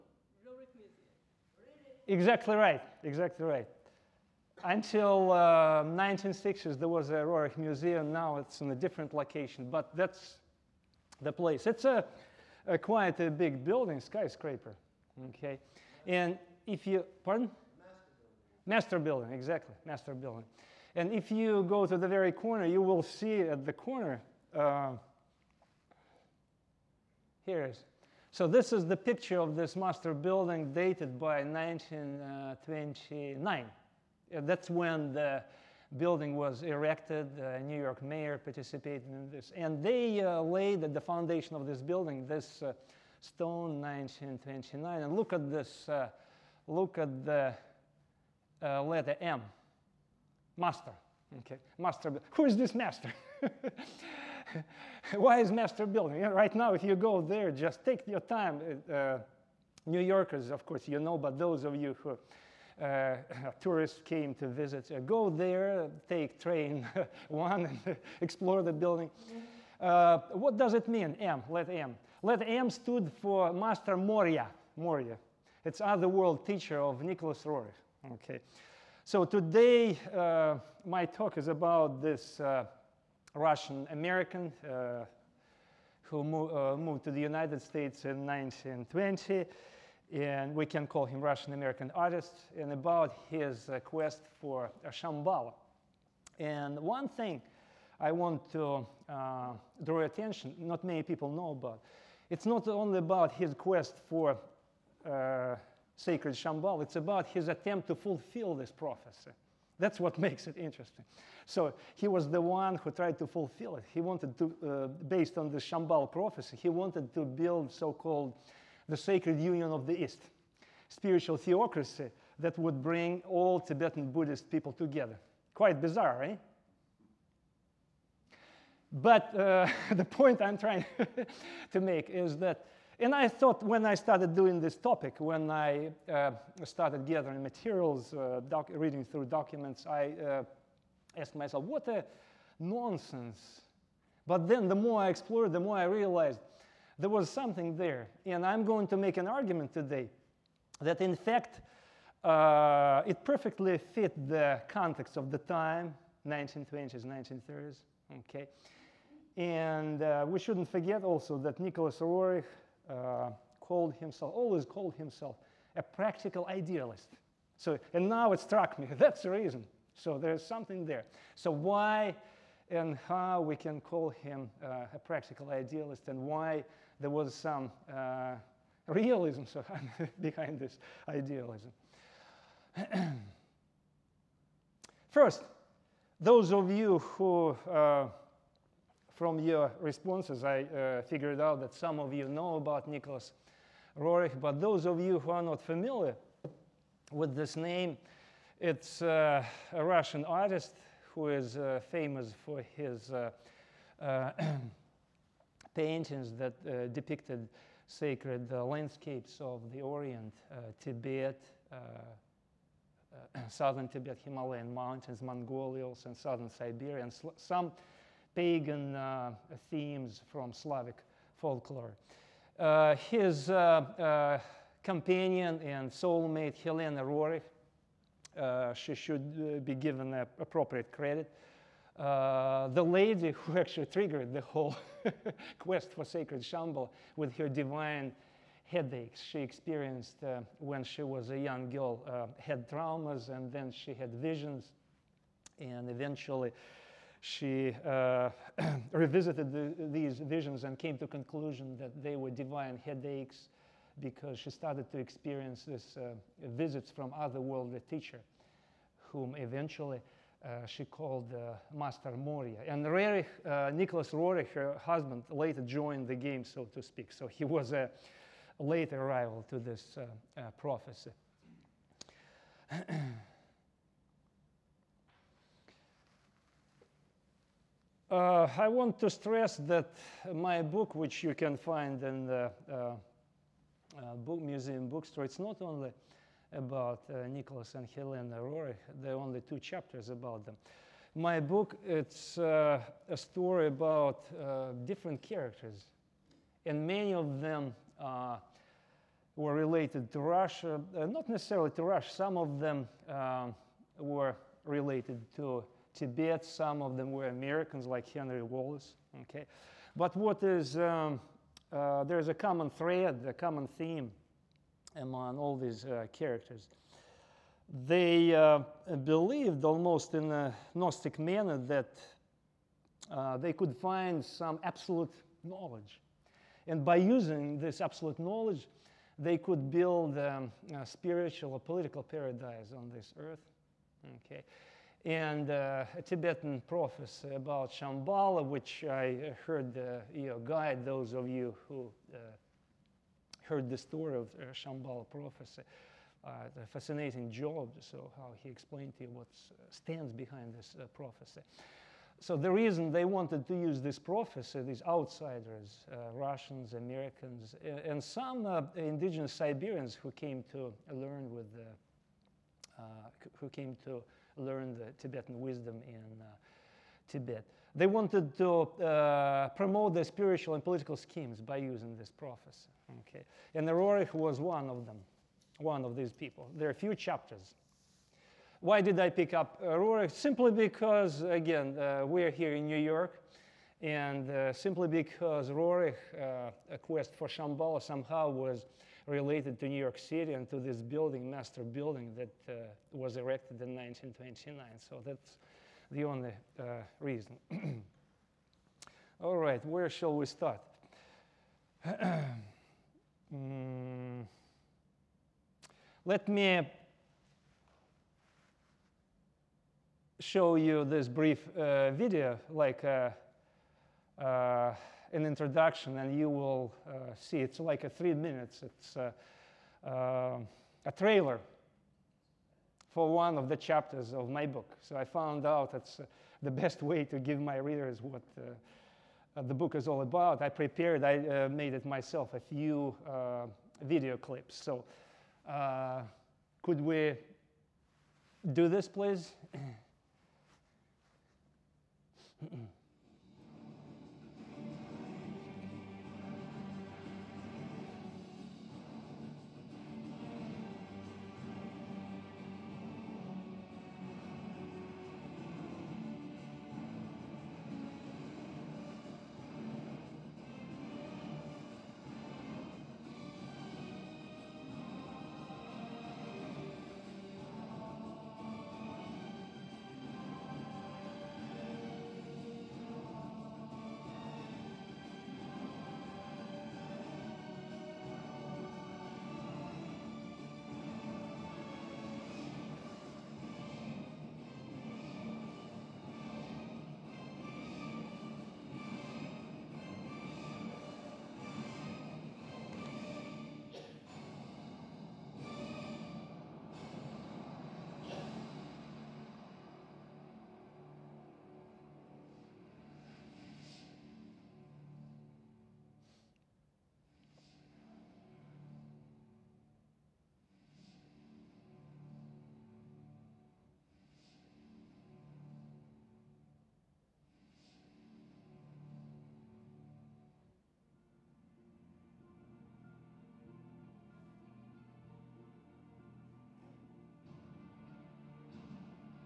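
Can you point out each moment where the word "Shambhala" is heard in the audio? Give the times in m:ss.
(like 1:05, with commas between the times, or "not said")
1:34, 1:46, 1:55, 3:56, 5:37, 5:44, 6:27.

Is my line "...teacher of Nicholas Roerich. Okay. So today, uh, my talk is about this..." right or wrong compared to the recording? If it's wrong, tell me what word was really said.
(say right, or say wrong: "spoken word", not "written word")
right.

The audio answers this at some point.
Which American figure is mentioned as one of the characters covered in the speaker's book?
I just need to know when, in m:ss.
5:08.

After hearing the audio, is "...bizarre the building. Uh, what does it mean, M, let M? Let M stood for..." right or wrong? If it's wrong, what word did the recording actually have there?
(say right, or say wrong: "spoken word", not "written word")
wrong: "explore", not "bizarre".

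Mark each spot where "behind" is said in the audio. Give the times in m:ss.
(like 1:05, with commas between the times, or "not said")
3:00, 5:50.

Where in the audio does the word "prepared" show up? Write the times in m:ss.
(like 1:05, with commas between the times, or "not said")
7:10.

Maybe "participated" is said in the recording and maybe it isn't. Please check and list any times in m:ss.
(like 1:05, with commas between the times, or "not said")
0:38.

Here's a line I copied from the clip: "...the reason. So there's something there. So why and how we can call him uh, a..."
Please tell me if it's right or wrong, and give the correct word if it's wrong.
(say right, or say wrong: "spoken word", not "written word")
right.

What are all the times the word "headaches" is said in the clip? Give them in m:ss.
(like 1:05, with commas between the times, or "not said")
3:58, 4:12.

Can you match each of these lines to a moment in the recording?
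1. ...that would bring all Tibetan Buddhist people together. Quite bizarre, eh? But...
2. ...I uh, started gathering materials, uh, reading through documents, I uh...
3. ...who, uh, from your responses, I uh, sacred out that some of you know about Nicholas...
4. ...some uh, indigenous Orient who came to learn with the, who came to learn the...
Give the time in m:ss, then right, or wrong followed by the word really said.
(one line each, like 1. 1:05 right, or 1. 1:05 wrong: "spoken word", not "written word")
1. 2:02 right
2. 2:15 right
3. 3:06 wrong: "figured", not "sacred"
4. 5:58 wrong: "Siberians", not "Orient".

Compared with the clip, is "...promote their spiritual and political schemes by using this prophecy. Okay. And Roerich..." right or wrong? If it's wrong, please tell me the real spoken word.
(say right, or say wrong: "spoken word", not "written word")
right.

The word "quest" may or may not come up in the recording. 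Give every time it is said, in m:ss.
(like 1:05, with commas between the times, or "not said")
1:33, 1:43, 3:55, 6:26.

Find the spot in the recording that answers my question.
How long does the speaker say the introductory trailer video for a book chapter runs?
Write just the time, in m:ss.
6:57.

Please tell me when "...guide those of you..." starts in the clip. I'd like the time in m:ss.
5:40.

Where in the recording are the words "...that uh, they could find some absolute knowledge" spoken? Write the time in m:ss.
5:21.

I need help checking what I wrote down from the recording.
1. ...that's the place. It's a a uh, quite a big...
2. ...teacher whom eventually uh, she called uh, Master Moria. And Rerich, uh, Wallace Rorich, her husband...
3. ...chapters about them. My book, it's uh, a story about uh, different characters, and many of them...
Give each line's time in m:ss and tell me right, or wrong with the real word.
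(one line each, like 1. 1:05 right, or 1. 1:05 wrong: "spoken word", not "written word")
1. 0:09 right
2. 4:17 wrong: "Nicholas", not "Wallace"
3. 4:49 right.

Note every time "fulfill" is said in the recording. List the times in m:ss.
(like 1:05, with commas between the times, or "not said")
1:47, 1:53.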